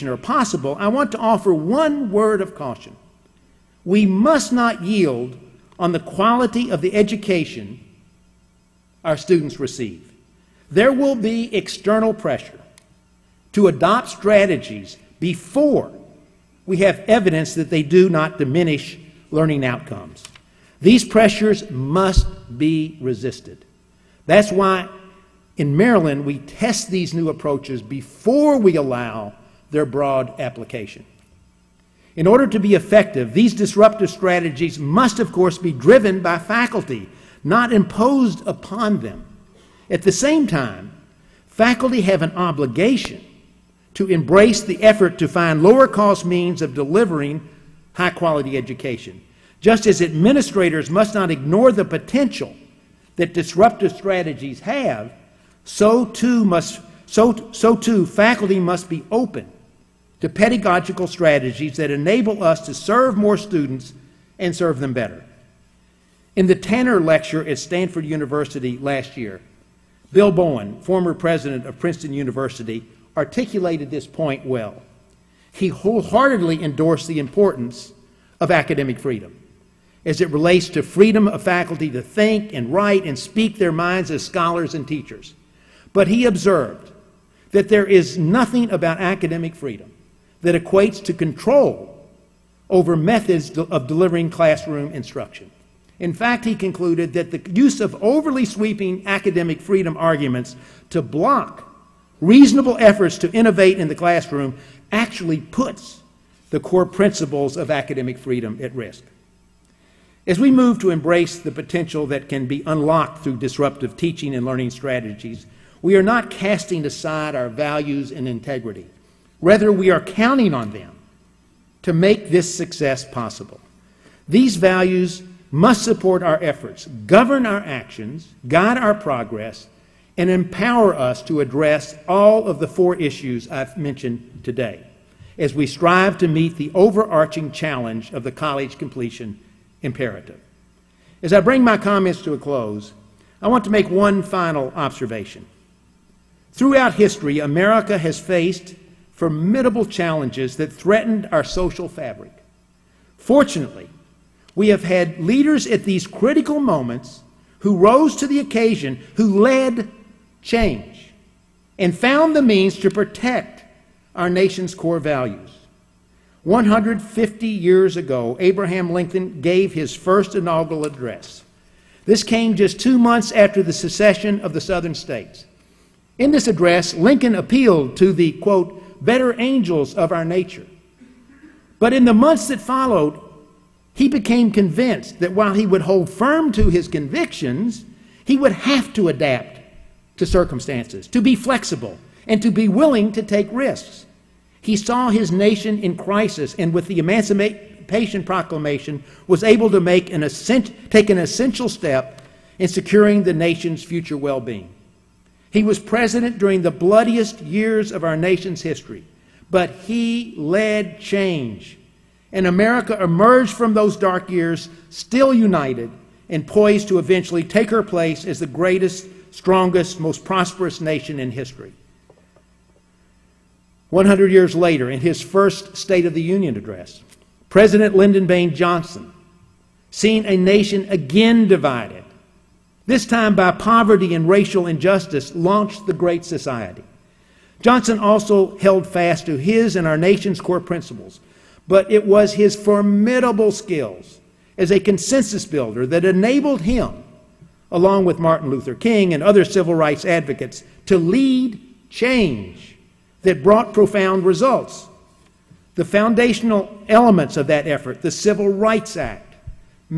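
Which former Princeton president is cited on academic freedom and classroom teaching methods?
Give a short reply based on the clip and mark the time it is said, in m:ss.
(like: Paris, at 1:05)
Bill Bowen, at 1:10.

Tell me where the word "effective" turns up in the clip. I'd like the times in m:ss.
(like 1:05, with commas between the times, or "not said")
0:32.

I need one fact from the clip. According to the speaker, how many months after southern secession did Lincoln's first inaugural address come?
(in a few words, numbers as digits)
2.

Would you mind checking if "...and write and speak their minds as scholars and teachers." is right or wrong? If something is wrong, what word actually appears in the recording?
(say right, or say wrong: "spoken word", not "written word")
right.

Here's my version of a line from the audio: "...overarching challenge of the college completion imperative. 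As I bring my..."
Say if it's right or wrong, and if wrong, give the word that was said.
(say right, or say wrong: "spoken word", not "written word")
right.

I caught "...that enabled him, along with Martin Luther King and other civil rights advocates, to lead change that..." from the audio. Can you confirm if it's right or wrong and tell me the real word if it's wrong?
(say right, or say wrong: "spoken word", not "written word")
right.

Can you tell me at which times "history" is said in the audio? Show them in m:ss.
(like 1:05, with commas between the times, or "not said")
2:26, 3:28, 3:41.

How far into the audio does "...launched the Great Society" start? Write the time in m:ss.
3:55.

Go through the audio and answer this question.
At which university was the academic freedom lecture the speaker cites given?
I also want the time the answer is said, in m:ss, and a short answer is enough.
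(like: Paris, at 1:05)
Stanford University, at 1:07.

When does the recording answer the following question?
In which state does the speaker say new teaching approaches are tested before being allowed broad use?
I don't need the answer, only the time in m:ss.
0:25.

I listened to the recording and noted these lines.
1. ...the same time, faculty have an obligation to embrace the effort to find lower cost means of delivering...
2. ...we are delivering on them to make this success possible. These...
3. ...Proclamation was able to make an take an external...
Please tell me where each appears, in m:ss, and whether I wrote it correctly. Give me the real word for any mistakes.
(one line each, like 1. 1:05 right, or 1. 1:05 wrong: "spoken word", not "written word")
1. 0:40 right
2. 1:59 wrong: "counting", not "delivering"
3. 3:18 wrong: "essential", not "external".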